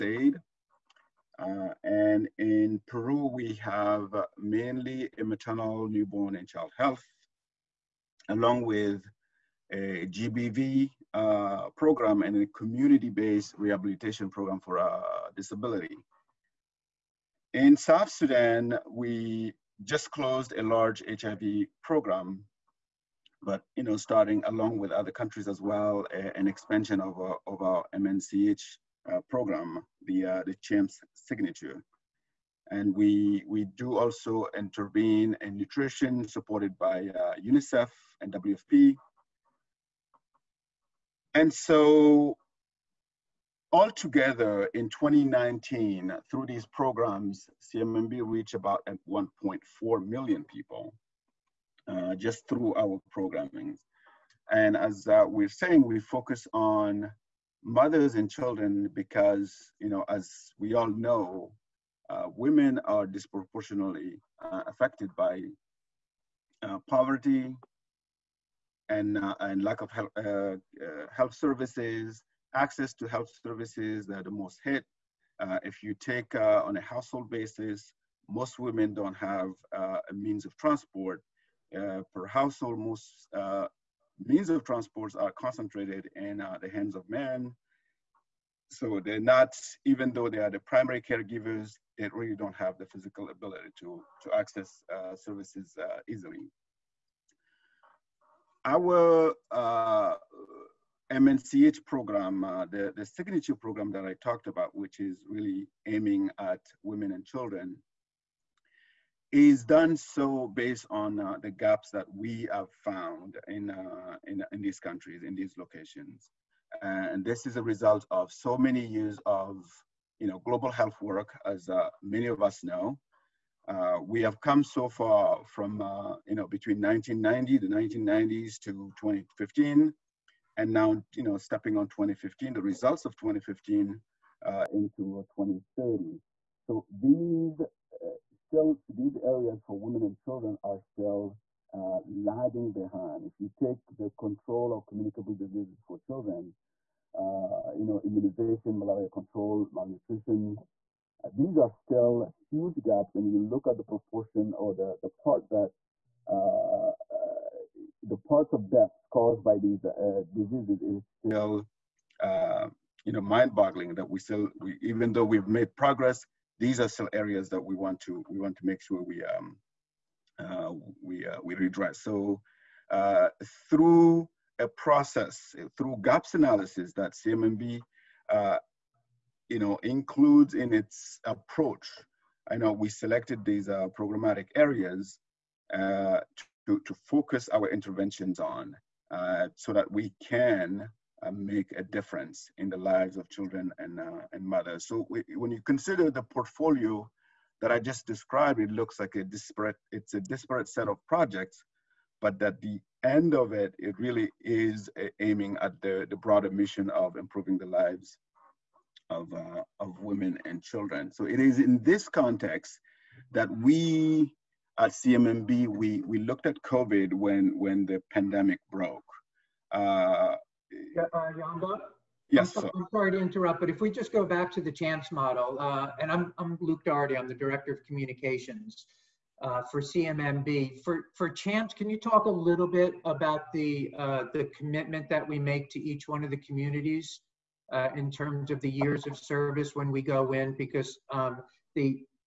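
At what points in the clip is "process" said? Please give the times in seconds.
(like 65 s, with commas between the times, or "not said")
174 s.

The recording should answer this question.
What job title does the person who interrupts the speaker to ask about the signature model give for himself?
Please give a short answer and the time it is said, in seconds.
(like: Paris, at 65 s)
Director of Communications, at 227 s.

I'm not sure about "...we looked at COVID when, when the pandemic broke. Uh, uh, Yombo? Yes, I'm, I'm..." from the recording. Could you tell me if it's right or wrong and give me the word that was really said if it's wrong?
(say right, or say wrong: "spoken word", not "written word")
right.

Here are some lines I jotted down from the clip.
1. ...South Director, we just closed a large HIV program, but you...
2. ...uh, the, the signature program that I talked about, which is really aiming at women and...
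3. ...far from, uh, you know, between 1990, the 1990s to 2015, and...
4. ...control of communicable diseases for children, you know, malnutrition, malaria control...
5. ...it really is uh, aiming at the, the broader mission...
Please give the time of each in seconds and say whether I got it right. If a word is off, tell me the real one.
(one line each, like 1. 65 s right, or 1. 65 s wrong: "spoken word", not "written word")
1. 17 s wrong: "Sudan", not "Director"
2. 102 s right
3. 124 s right
4. 144 s wrong: "immunization", not "malnutrition"
5. 203 s right.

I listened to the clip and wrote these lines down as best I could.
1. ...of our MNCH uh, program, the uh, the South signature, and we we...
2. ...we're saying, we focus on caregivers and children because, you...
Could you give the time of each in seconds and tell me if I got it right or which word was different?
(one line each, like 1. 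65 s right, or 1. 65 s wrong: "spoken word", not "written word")
1. 27 s wrong: "CHAMPS", not "South"
2. 55 s wrong: "mothers", not "caregivers".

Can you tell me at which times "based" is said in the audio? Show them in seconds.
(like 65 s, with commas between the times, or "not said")
12 s, 110 s.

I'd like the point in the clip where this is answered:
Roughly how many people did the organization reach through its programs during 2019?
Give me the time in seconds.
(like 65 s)
49 s.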